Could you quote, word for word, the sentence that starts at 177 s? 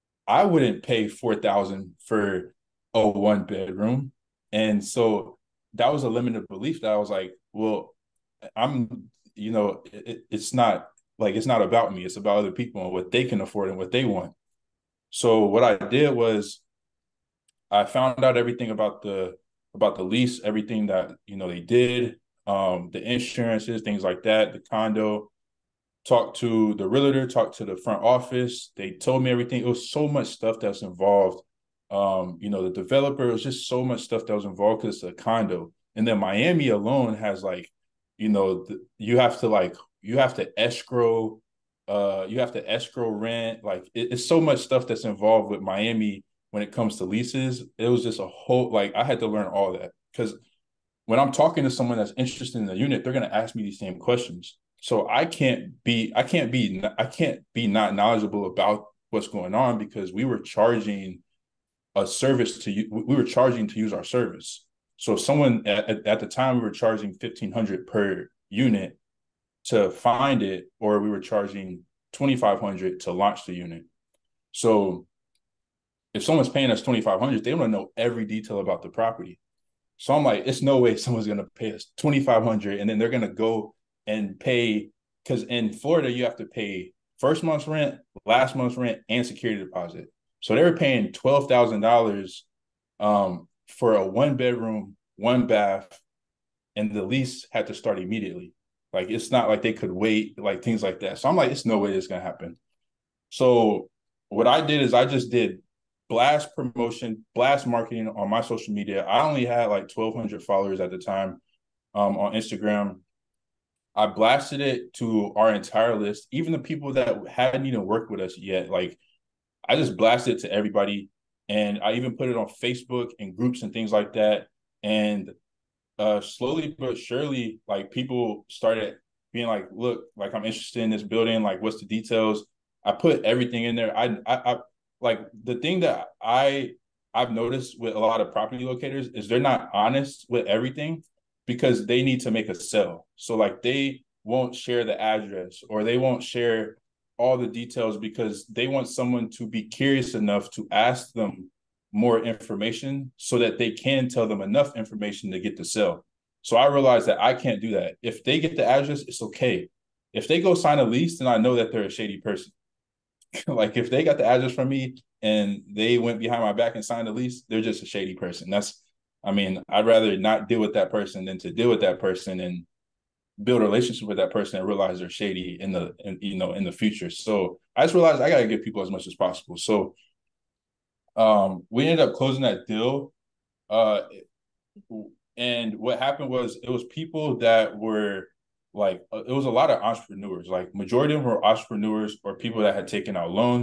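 So I just realized I gotta give people as much as possible.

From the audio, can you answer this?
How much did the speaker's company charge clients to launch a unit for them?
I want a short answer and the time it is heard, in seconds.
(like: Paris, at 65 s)
2500, at 72 s.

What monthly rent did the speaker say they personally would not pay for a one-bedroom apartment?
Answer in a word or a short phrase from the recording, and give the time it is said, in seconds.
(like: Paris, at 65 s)
4000, at 1 s.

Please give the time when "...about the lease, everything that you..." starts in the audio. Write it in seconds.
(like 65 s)
19 s.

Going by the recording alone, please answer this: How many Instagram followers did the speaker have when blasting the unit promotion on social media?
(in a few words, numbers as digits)
1200.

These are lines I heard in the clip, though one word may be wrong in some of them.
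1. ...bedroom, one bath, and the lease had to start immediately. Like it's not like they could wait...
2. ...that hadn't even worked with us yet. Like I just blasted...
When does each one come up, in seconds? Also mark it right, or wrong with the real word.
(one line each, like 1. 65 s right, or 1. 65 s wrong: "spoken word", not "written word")
1. 94 s right
2. 116 s right.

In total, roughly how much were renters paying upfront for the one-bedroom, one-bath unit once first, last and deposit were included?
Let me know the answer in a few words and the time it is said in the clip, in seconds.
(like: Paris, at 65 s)
12000, at 91 s.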